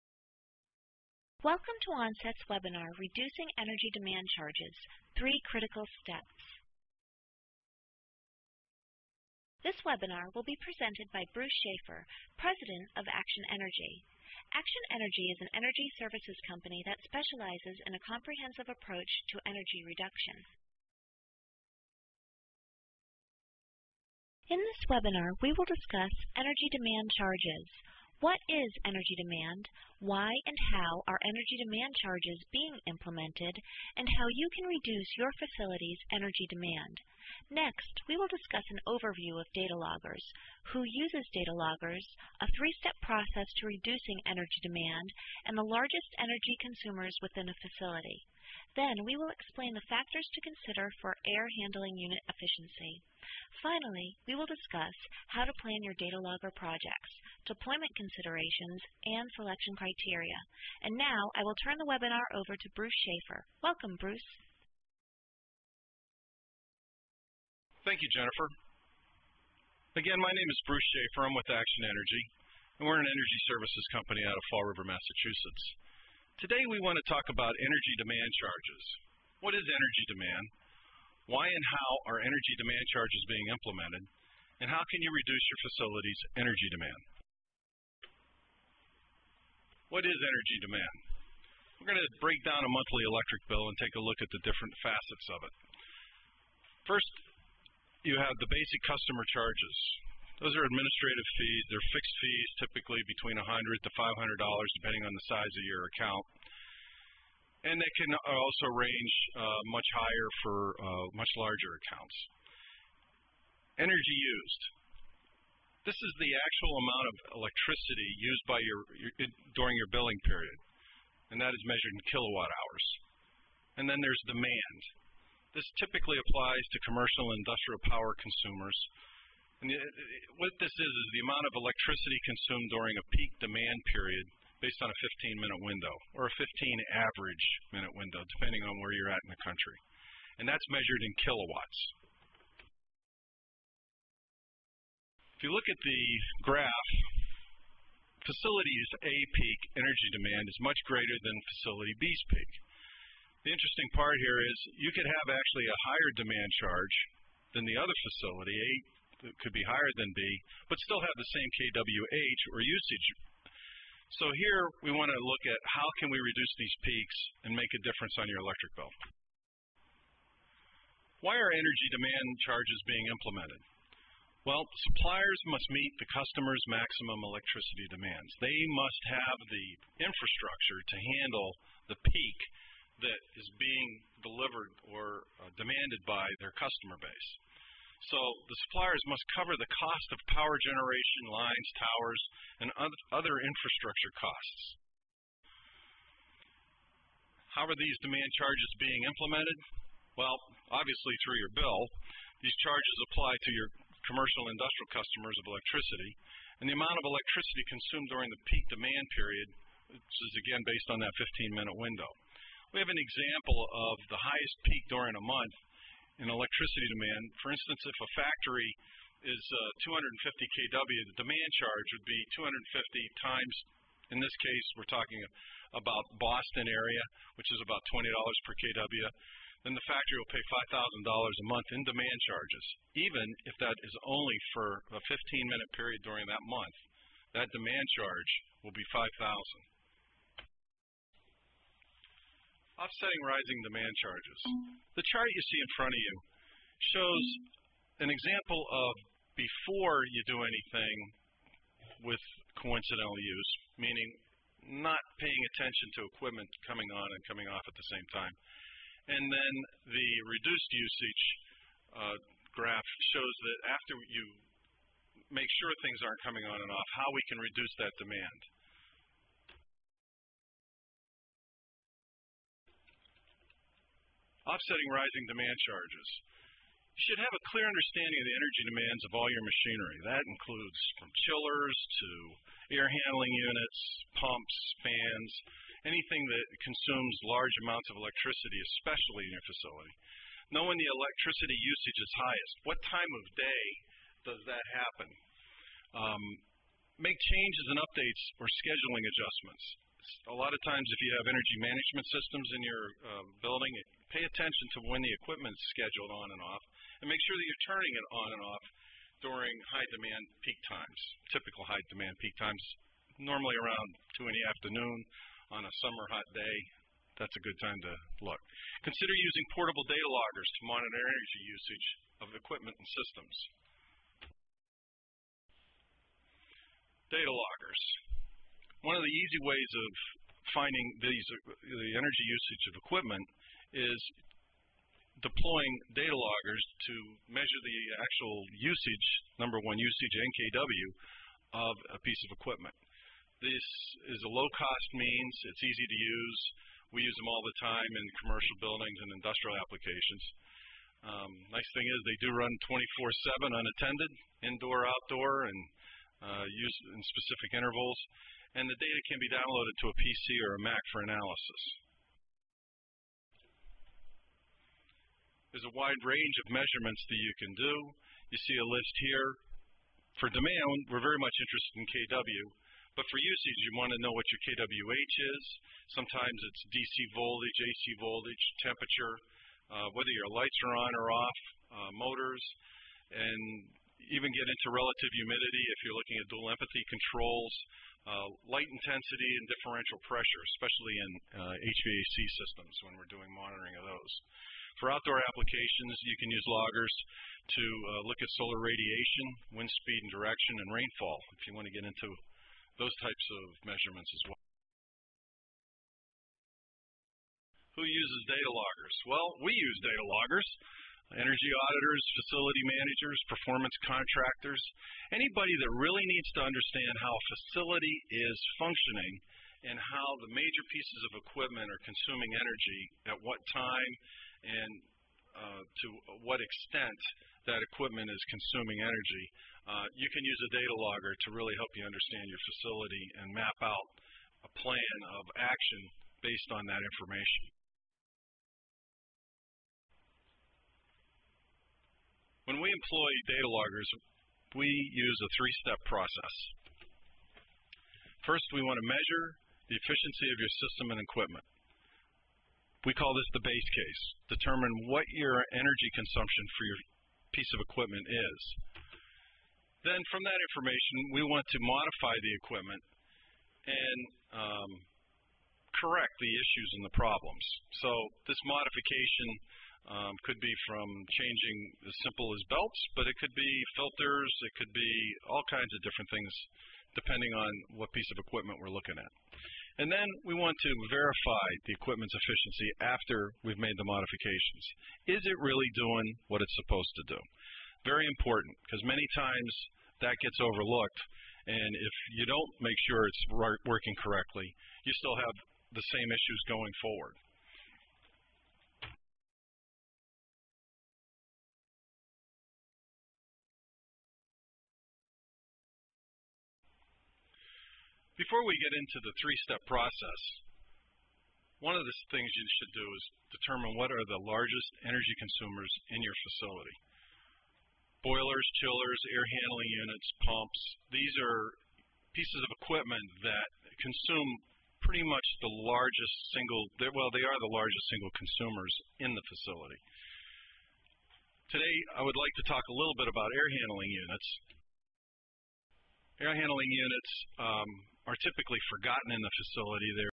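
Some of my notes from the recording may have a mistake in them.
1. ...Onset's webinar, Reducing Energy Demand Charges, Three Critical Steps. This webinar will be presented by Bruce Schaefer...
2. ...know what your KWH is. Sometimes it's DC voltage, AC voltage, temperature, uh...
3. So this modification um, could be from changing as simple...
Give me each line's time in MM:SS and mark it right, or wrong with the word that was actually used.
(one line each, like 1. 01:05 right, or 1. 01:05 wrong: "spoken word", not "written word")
1. 00:01 right
2. 06:14 right
3. 07:47 right.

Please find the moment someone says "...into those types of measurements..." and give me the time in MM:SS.
06:41.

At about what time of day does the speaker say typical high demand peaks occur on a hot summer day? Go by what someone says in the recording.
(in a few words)
2 in the afternoon.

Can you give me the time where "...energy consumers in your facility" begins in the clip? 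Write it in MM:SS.
08:34.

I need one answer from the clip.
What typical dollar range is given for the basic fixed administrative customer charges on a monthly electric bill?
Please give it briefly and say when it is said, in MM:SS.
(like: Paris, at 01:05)
$100 to $500, at 01:43.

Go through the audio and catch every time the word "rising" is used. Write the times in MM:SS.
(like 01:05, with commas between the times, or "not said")
04:03, 04:34.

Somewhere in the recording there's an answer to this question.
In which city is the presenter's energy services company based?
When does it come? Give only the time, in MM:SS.
01:14.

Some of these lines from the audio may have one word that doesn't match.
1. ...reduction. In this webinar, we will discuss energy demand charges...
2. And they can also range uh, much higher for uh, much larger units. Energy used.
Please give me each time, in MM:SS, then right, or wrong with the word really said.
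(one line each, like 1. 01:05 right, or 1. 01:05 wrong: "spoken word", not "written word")
1. 00:19 right
2. 01:47 wrong: "accounts", not "units".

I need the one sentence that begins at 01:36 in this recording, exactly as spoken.
First, you have the basic customer charges.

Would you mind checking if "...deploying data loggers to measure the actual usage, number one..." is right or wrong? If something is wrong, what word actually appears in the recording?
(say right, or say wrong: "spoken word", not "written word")
right.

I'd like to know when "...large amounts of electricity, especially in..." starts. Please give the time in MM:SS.
04:47.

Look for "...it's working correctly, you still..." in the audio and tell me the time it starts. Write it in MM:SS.
08:13.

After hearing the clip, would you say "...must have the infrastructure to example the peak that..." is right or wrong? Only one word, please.
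wrong.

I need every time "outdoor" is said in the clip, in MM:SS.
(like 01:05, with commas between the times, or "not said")
05:54, 06:34.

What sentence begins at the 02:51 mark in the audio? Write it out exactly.
Why are energy demand charges being implemented?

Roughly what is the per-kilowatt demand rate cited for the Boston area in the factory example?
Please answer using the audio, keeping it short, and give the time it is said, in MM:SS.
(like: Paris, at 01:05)
$20 per kW, at 03:47.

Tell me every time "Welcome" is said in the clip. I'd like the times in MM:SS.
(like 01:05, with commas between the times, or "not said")
00:01, 01:03.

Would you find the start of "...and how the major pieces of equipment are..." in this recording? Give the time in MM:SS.
06:59.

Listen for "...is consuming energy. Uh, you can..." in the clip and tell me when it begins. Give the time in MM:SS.
07:08.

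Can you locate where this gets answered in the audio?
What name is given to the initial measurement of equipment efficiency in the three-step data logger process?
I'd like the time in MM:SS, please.
07:33.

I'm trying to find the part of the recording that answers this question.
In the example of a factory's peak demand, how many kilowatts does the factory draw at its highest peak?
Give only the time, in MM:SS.
03:39.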